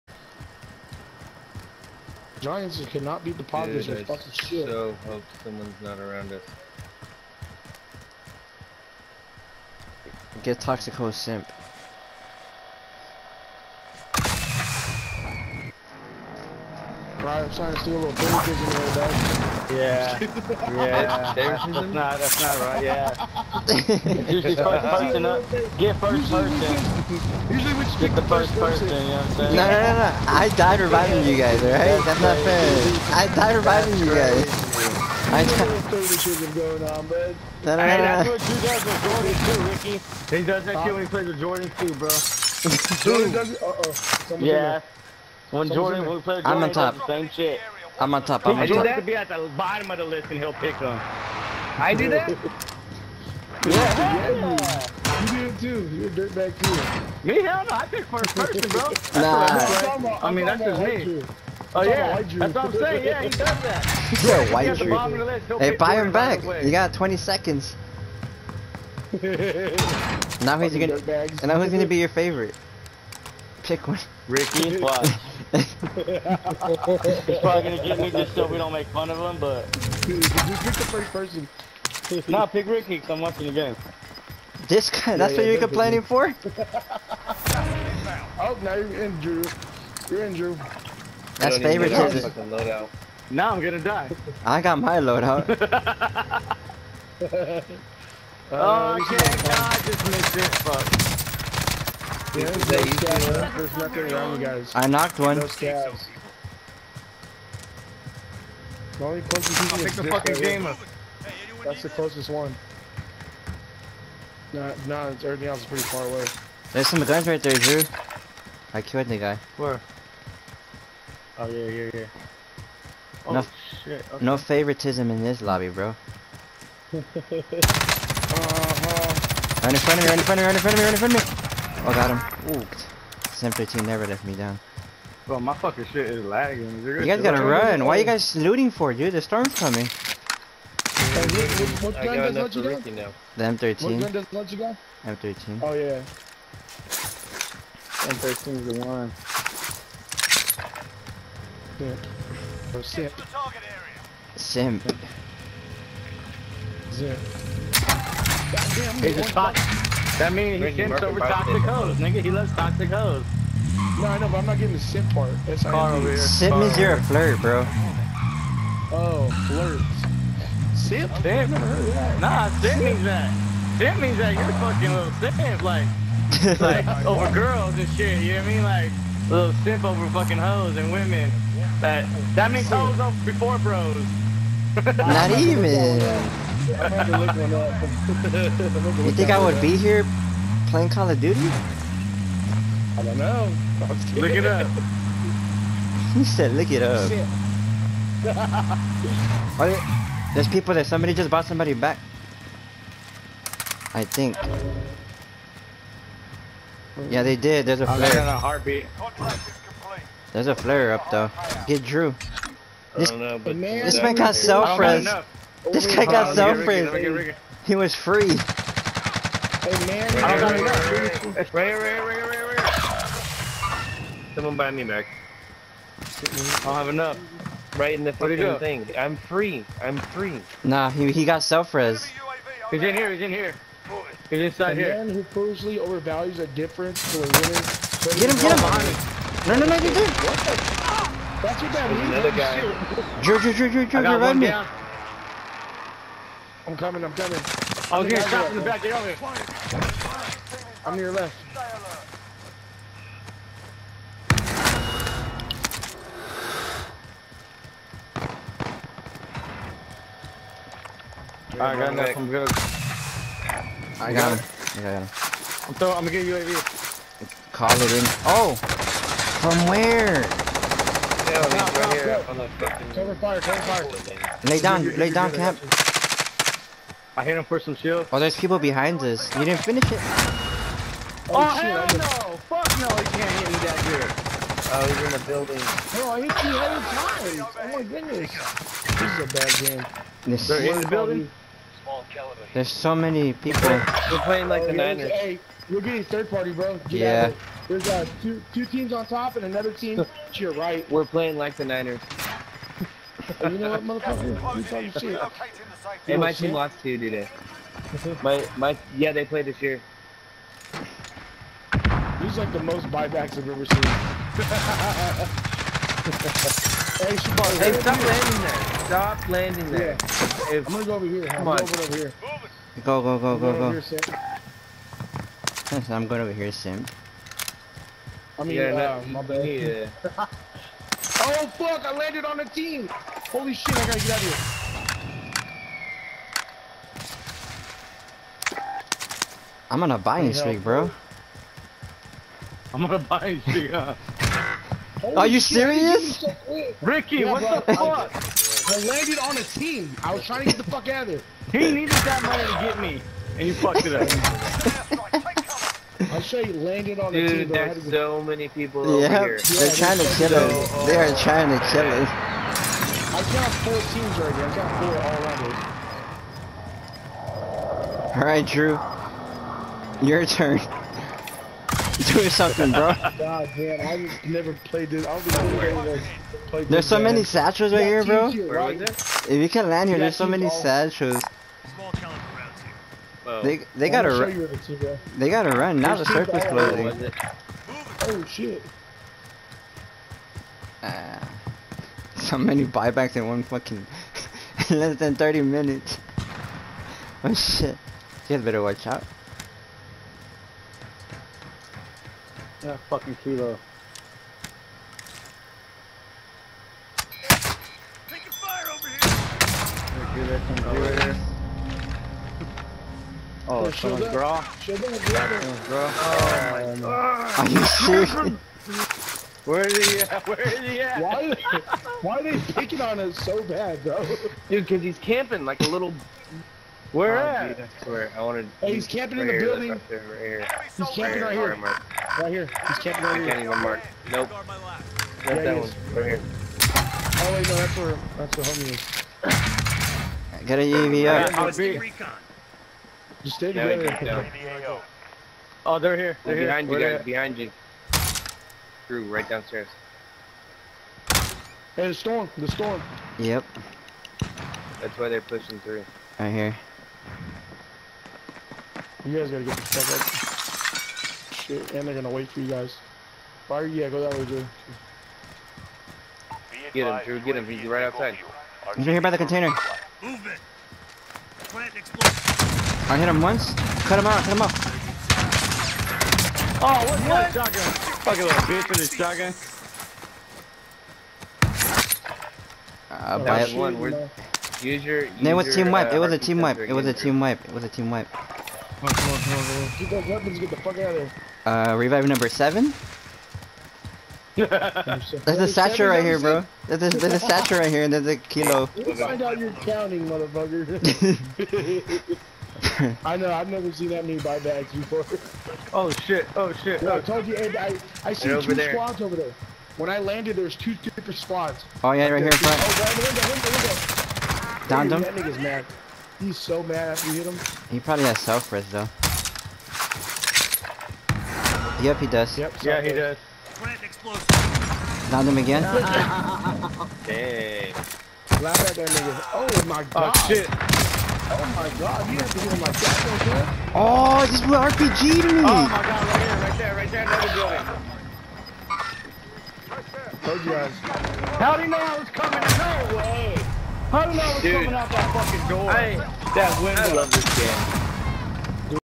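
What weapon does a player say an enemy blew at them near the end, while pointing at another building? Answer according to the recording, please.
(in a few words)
RPG.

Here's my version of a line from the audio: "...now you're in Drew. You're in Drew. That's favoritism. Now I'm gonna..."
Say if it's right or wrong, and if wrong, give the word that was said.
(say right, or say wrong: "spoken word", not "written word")
right.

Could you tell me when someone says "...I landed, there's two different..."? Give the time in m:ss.
8:29.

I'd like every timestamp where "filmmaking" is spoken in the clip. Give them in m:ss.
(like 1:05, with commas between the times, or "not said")
not said.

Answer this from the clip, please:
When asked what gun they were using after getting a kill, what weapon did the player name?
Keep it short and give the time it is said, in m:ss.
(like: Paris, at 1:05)
M13, at 2:22.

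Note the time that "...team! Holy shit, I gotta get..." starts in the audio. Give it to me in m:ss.
5:32.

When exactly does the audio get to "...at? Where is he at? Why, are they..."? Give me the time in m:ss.
7:00.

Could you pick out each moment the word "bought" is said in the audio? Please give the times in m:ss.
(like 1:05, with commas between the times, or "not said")
3:21.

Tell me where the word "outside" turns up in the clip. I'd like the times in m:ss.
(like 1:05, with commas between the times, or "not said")
7:47.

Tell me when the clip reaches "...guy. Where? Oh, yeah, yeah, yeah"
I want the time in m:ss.
1:59.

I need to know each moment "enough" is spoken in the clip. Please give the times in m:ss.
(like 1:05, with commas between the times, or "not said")
3:40, 3:46, 4:21.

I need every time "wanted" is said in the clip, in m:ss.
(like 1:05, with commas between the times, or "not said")
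7:08.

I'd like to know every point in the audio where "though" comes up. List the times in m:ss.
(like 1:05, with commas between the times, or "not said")
0:18, 3:31, 8:38.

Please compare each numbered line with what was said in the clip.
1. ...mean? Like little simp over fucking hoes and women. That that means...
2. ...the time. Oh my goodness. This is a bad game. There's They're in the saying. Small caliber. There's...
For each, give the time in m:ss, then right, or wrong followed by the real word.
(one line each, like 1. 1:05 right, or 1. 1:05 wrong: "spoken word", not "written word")
1. 2:58 right
2. 4:47 wrong: "building", not "saying".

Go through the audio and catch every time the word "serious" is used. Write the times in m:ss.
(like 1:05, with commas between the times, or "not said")
5:45, 6:57.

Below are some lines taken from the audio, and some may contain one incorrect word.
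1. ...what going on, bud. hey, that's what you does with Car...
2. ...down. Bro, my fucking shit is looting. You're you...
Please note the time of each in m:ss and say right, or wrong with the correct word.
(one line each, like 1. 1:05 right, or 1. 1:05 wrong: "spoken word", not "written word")
1. 0:35 wrong: "Jordan", not "Car"
2. 2:14 wrong: "lagging", not "looting".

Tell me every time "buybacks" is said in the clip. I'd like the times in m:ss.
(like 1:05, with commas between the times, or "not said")
5:12, 6:32.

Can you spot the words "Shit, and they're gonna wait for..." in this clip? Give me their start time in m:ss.
7:41.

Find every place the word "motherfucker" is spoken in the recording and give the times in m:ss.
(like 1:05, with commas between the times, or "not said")
5:03, 8:20.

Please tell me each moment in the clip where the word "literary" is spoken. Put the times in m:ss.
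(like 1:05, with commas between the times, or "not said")
not said.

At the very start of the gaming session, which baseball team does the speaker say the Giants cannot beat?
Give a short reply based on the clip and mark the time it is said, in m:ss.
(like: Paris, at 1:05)
Padres, at 0:03.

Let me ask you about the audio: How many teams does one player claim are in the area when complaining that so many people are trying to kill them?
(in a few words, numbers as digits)
4.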